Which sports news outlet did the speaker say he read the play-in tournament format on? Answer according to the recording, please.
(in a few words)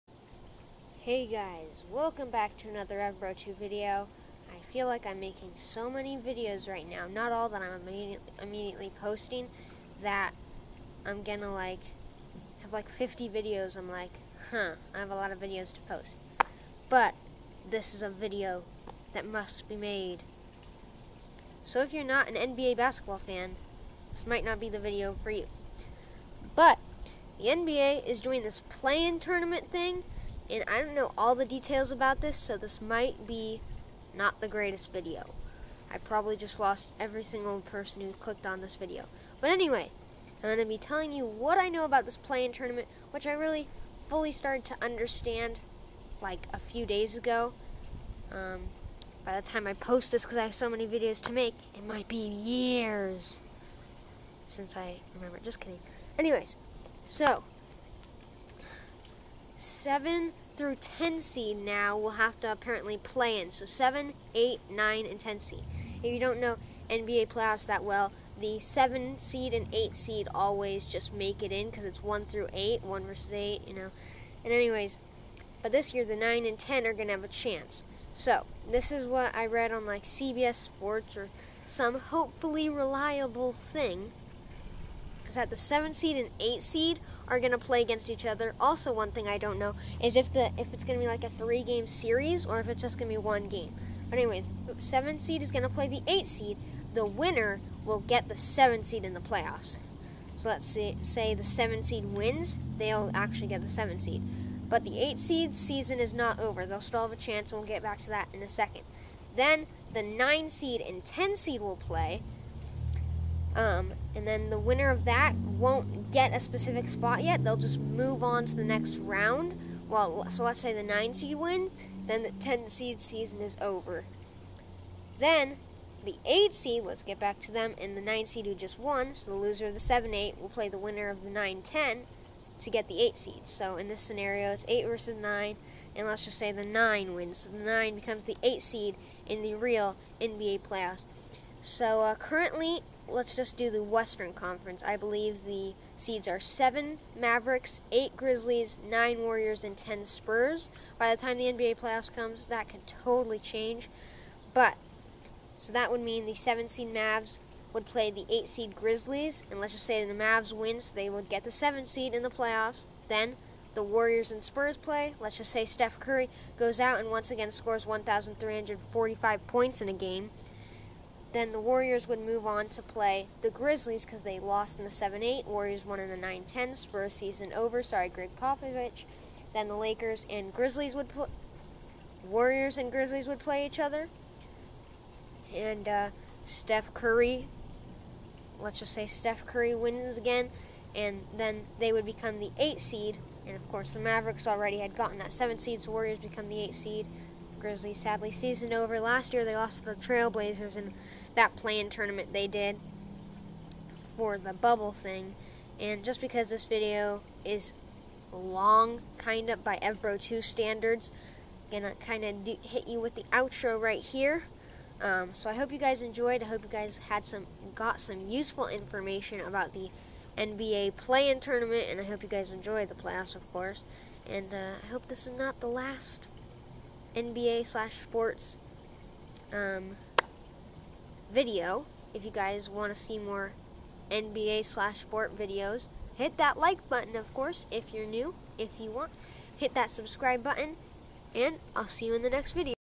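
CBS Sports.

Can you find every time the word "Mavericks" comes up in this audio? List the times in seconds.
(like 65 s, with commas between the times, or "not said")
147 s, 194 s.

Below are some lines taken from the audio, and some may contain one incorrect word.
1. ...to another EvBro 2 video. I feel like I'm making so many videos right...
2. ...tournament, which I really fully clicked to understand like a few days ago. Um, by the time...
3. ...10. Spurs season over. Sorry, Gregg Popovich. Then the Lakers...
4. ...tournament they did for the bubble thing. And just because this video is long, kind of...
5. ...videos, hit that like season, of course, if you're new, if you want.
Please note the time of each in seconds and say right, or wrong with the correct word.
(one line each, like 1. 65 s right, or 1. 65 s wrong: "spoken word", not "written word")
1. 2 s right
2. 42 s wrong: "started", not "clicked"
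3. 176 s right
4. 201 s right
5. 235 s wrong: "button", not "season".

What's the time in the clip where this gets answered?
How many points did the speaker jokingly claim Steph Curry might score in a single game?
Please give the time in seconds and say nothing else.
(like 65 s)
167 s.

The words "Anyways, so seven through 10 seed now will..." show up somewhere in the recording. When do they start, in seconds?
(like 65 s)
56 s.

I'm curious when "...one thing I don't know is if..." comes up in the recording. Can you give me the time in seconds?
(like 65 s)
88 s.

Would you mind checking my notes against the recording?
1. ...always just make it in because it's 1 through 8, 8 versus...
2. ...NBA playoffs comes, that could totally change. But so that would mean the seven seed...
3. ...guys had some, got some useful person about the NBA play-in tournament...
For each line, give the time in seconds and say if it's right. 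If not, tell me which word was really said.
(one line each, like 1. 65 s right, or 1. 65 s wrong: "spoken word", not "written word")
1. 70 s wrong: "1", not "8"
2. 151 s right
3. 216 s wrong: "information", not "person".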